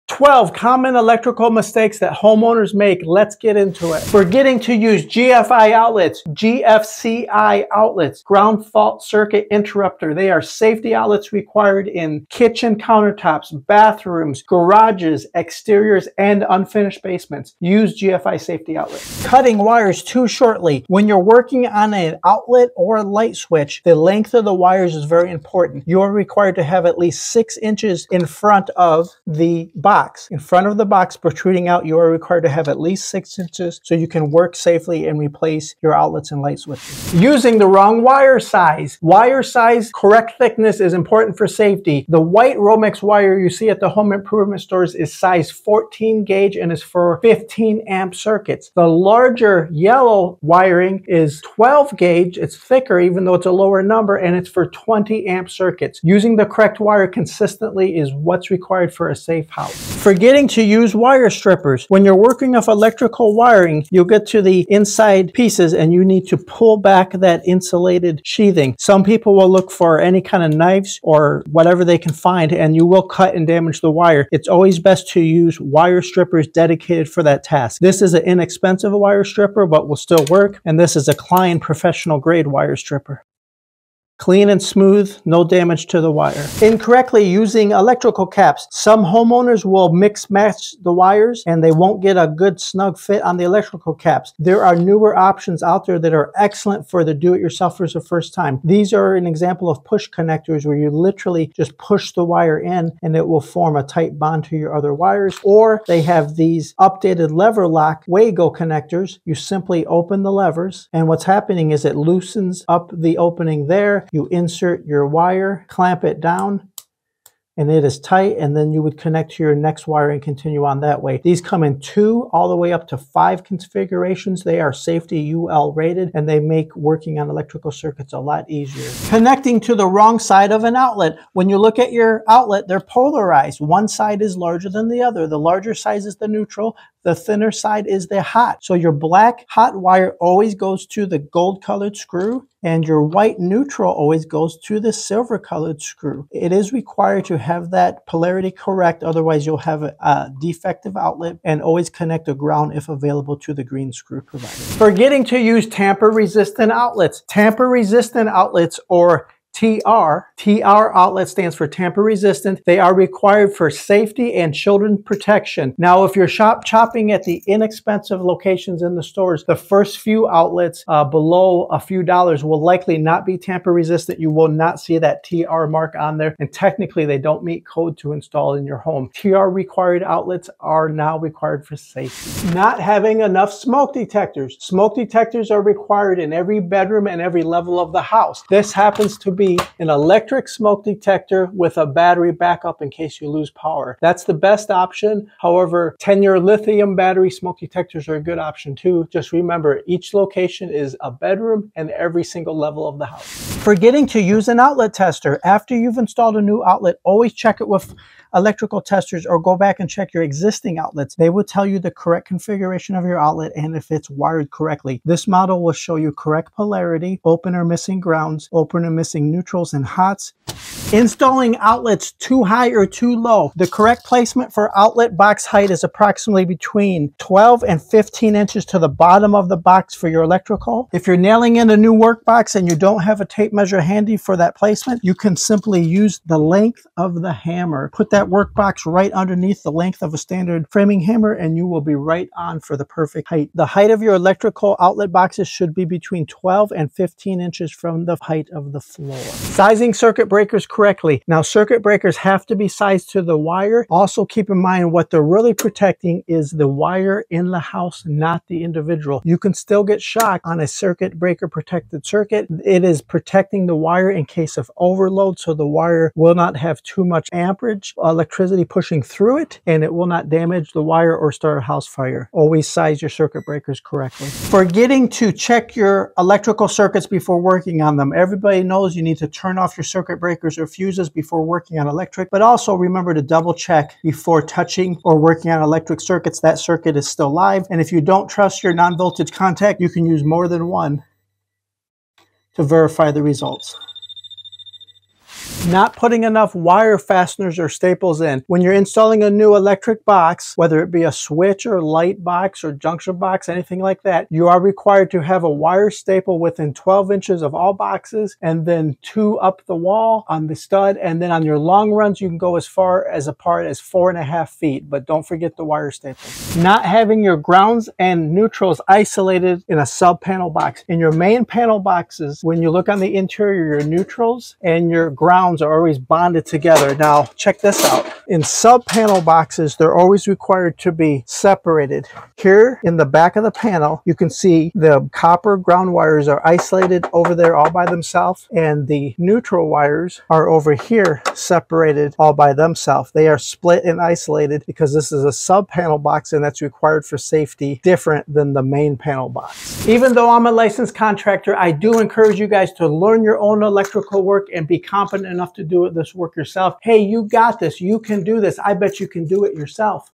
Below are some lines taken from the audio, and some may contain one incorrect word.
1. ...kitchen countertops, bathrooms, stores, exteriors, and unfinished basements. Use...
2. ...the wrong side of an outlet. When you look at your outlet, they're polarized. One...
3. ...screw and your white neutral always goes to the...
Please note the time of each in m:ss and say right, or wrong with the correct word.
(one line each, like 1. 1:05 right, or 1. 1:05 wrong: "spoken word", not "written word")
1. 0:12 wrong: "garages", not "stores"
2. 2:09 right
3. 2:21 right.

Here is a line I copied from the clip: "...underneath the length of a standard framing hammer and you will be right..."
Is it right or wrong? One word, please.
right.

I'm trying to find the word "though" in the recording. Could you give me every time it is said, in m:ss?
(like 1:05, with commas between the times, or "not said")
0:53, 5:50.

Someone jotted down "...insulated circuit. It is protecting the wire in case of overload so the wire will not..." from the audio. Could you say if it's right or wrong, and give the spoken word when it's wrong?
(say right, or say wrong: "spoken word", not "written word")
wrong: "protected", not "insulated".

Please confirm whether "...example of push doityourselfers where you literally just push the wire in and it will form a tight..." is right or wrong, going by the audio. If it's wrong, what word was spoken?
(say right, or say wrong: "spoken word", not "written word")
wrong: "connectors", not "doityourselfers".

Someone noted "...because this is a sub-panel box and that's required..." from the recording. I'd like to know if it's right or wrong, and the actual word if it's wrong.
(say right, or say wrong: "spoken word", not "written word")
right.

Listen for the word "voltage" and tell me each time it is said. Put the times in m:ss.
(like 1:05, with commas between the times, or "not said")
4:48.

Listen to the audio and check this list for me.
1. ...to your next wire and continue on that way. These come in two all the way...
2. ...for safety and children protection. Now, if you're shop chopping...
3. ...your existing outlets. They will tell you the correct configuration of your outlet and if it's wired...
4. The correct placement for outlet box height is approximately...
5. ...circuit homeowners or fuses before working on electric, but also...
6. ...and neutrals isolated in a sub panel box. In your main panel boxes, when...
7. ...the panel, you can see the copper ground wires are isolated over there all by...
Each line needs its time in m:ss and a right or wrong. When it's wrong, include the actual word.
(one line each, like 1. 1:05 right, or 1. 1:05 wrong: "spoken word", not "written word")
1. 1:59 right
2. 2:43 right
3. 3:30 right
4. 3:43 right
5. 4:39 wrong: "breakers", not "homeowners"
6. 5:17 right
7. 5:33 right.